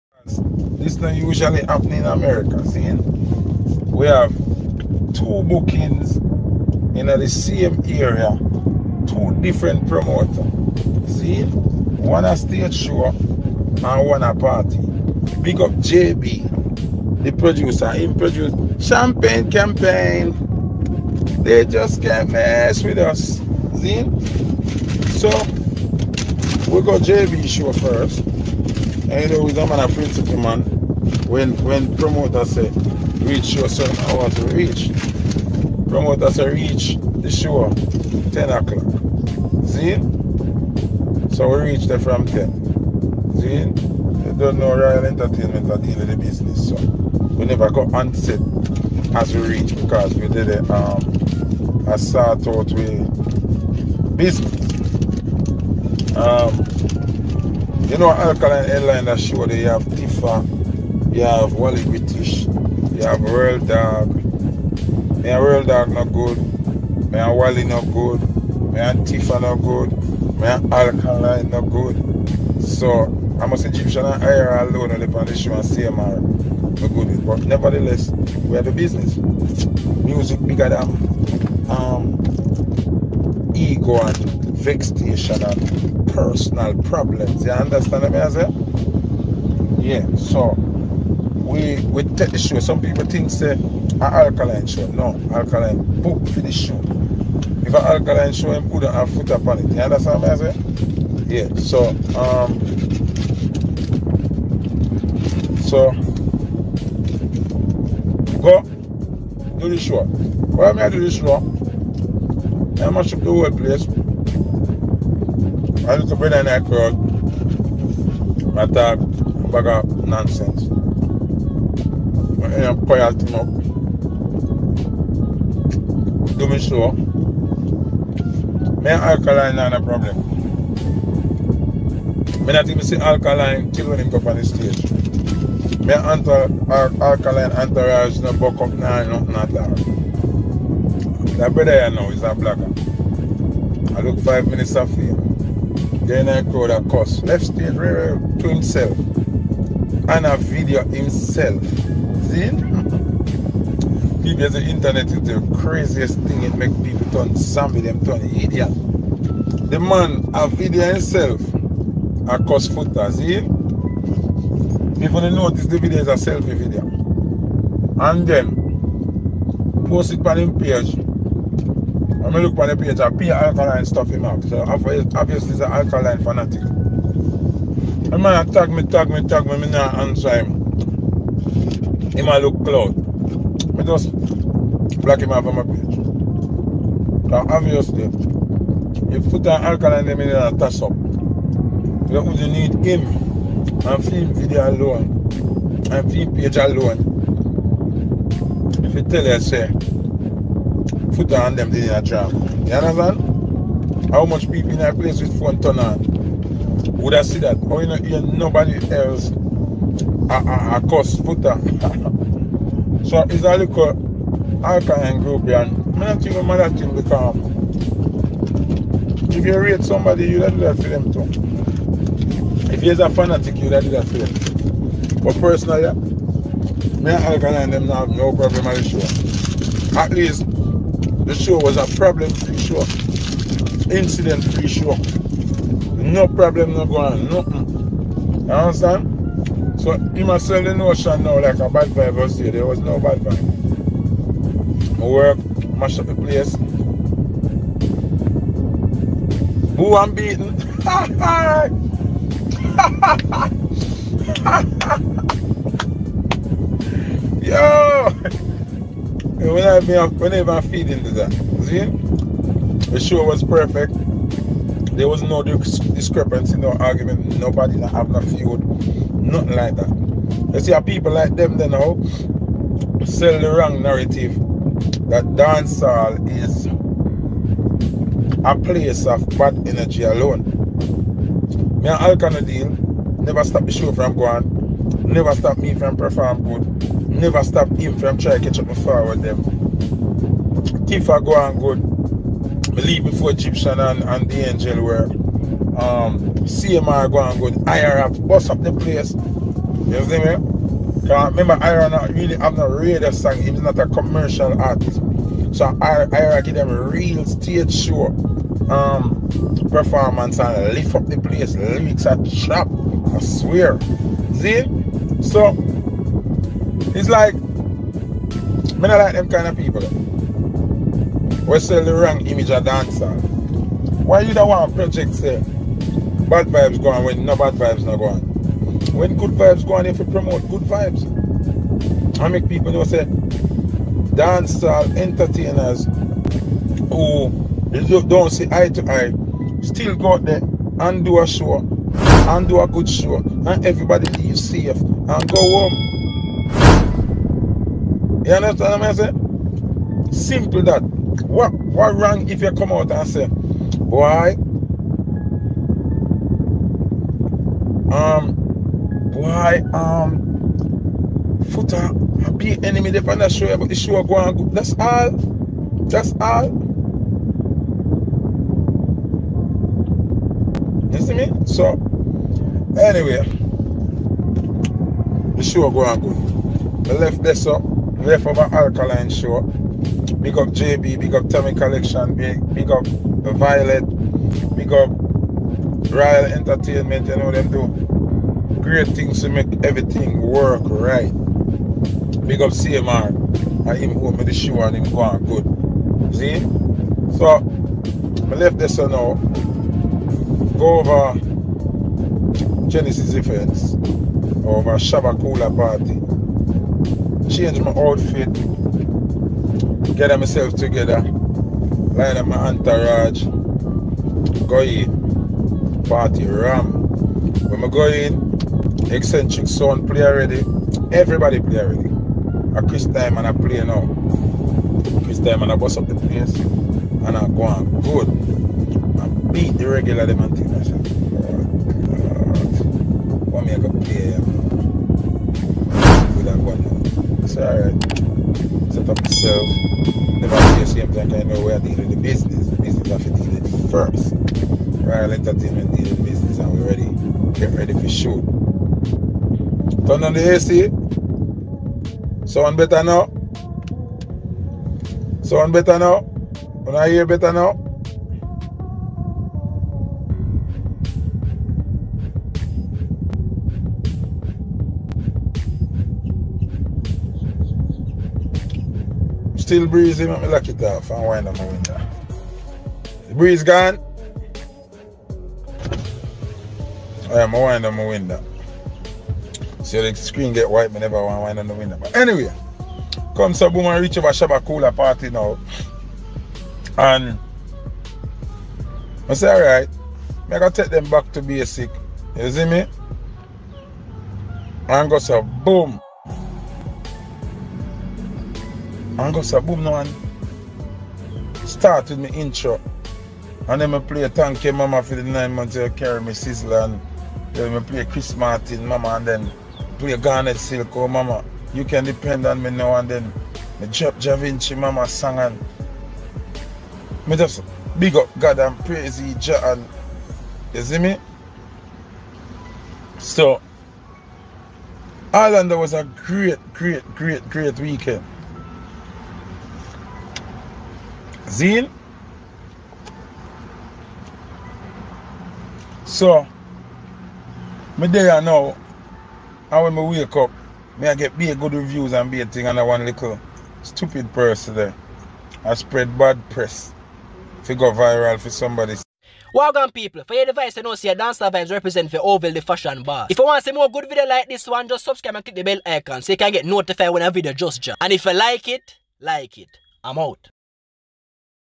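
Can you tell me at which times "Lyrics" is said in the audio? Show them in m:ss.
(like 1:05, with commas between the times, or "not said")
5:11.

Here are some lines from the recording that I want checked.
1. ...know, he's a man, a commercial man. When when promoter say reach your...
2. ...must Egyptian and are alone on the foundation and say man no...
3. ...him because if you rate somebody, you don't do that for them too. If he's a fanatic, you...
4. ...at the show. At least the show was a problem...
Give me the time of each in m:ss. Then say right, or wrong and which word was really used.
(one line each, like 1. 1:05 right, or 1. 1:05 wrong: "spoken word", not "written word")
1. 0:29 wrong: "principal", not "commercial"
2. 1:13 right
3. 3:36 right
4. 3:48 right.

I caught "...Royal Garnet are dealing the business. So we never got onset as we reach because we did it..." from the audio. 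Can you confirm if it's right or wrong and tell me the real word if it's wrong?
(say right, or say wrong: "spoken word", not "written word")
wrong: "Entertainment", not "Garnet".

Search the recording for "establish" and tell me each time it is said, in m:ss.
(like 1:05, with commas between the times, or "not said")
not said.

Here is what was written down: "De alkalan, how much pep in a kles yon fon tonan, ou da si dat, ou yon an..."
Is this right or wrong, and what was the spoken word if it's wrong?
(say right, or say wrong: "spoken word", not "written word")
wrong: "anazan", not "alkalan".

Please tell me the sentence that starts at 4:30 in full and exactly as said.
You see how people like them then how sell the wrong narrative that dancehall is a place of bad energy alone.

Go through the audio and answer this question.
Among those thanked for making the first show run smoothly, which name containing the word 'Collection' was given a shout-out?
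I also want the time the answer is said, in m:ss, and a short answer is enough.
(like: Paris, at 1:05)
Tommy Collection, at 6:21.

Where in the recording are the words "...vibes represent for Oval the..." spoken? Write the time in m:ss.
9:11.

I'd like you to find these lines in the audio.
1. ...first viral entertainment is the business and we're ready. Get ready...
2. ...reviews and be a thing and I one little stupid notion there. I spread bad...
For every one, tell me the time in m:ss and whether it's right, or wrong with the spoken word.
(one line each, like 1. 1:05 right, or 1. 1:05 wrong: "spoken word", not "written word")
1. 7:23 right
2. 9:01 wrong: "person", not "notion".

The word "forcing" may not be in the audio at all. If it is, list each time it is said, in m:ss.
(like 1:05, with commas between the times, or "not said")
not said.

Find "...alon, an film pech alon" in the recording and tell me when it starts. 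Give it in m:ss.
3:14.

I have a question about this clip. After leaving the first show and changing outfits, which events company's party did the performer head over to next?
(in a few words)
Genesis Events.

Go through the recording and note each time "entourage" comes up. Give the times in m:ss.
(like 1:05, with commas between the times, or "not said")
2:17, 6:52.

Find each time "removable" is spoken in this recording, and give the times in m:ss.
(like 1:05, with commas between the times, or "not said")
not said.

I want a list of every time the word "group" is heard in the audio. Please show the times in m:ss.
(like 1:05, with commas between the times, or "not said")
3:35.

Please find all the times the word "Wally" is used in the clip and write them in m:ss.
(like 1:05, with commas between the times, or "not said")
1:01, 1:07.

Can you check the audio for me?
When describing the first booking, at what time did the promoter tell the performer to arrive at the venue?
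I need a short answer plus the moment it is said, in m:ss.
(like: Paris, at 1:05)
10 o'clock, at 0:38.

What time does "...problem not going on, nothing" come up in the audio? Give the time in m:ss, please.
3:56.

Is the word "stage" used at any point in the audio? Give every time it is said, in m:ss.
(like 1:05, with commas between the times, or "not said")
0:12, 2:14, 2:27, 5:07.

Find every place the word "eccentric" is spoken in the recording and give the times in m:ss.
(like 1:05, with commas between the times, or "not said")
6:58.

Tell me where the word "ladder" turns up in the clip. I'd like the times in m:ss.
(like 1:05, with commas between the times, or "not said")
not said.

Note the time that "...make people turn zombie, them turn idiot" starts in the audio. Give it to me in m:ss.
2:36.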